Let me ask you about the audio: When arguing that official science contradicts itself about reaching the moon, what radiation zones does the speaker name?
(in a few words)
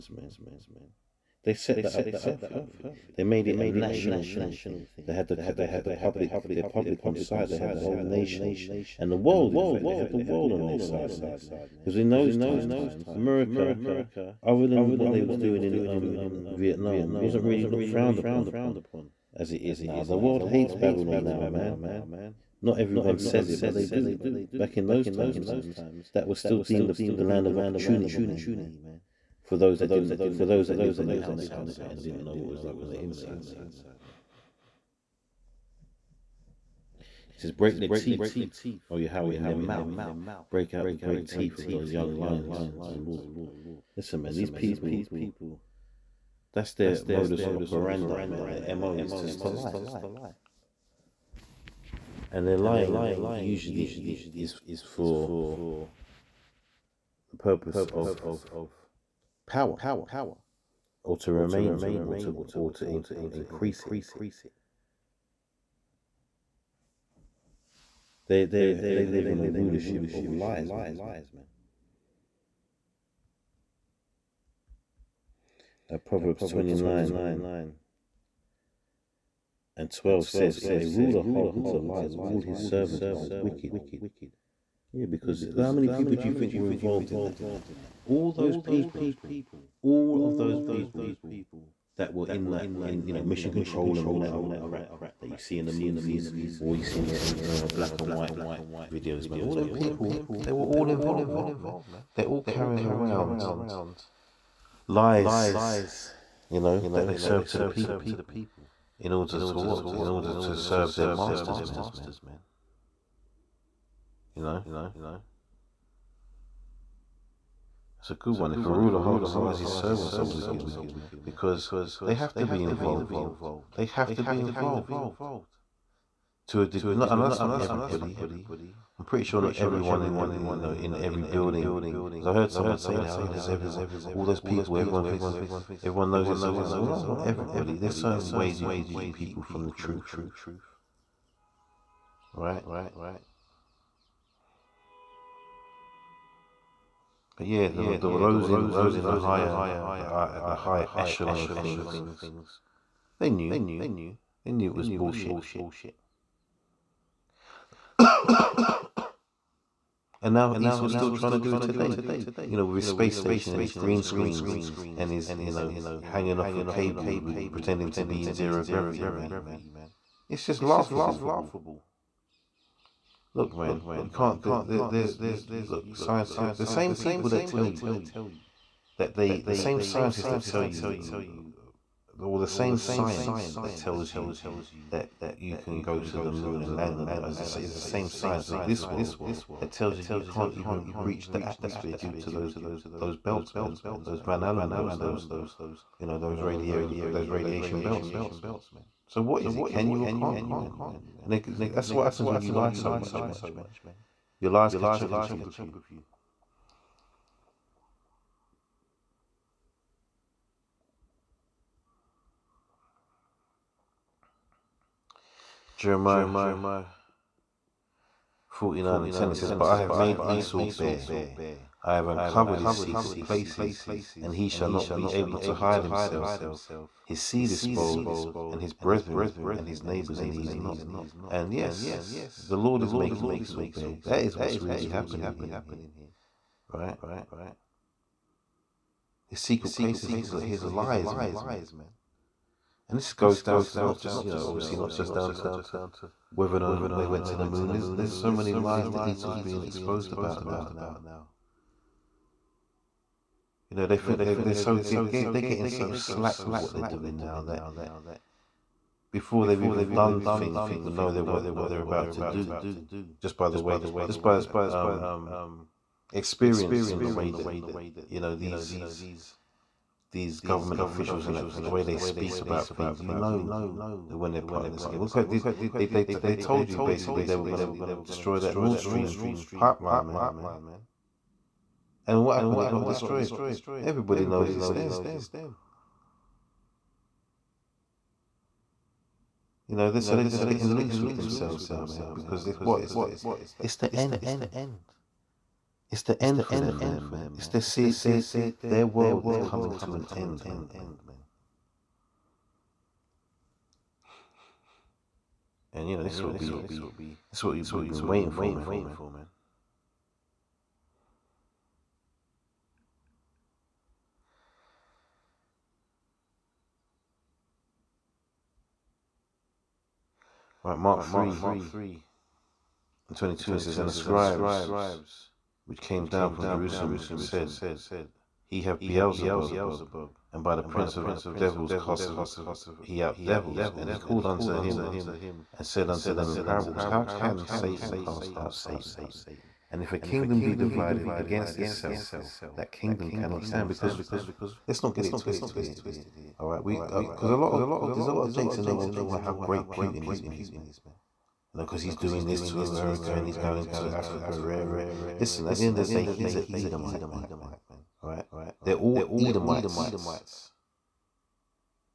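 Van Allen belts.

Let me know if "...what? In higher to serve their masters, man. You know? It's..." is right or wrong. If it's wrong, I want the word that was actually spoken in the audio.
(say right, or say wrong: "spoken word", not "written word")
wrong: "order", not "higher".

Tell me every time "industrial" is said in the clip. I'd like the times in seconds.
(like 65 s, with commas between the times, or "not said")
not said.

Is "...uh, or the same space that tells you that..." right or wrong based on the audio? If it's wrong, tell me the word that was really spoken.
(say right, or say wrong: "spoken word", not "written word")
wrong: "science", not "space".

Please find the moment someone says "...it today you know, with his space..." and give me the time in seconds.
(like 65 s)
161 s.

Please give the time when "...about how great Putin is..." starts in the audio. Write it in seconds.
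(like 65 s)
349 s.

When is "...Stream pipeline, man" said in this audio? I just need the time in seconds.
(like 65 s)
278 s.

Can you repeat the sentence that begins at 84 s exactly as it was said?
Yeah, because how many people do you think were involved in that?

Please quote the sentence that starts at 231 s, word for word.
And yes, the Lord is making Esau bare.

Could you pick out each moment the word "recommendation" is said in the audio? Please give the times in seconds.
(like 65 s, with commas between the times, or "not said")
not said.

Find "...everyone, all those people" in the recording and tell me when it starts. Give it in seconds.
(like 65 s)
133 s.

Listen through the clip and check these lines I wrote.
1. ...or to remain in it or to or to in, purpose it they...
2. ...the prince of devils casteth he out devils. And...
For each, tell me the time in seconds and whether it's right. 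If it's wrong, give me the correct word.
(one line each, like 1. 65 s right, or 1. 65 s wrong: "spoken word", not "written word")
1. 61 s wrong: "increase", not "purpose"
2. 330 s right.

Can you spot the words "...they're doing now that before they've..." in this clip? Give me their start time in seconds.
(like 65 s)
256 s.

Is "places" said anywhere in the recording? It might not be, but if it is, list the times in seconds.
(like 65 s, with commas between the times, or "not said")
223 s, 239 s.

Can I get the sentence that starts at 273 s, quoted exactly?
You know when they're plotting this scheme.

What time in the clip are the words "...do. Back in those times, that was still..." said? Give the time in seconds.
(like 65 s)
23 s.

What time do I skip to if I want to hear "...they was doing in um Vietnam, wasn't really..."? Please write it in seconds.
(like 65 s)
15 s.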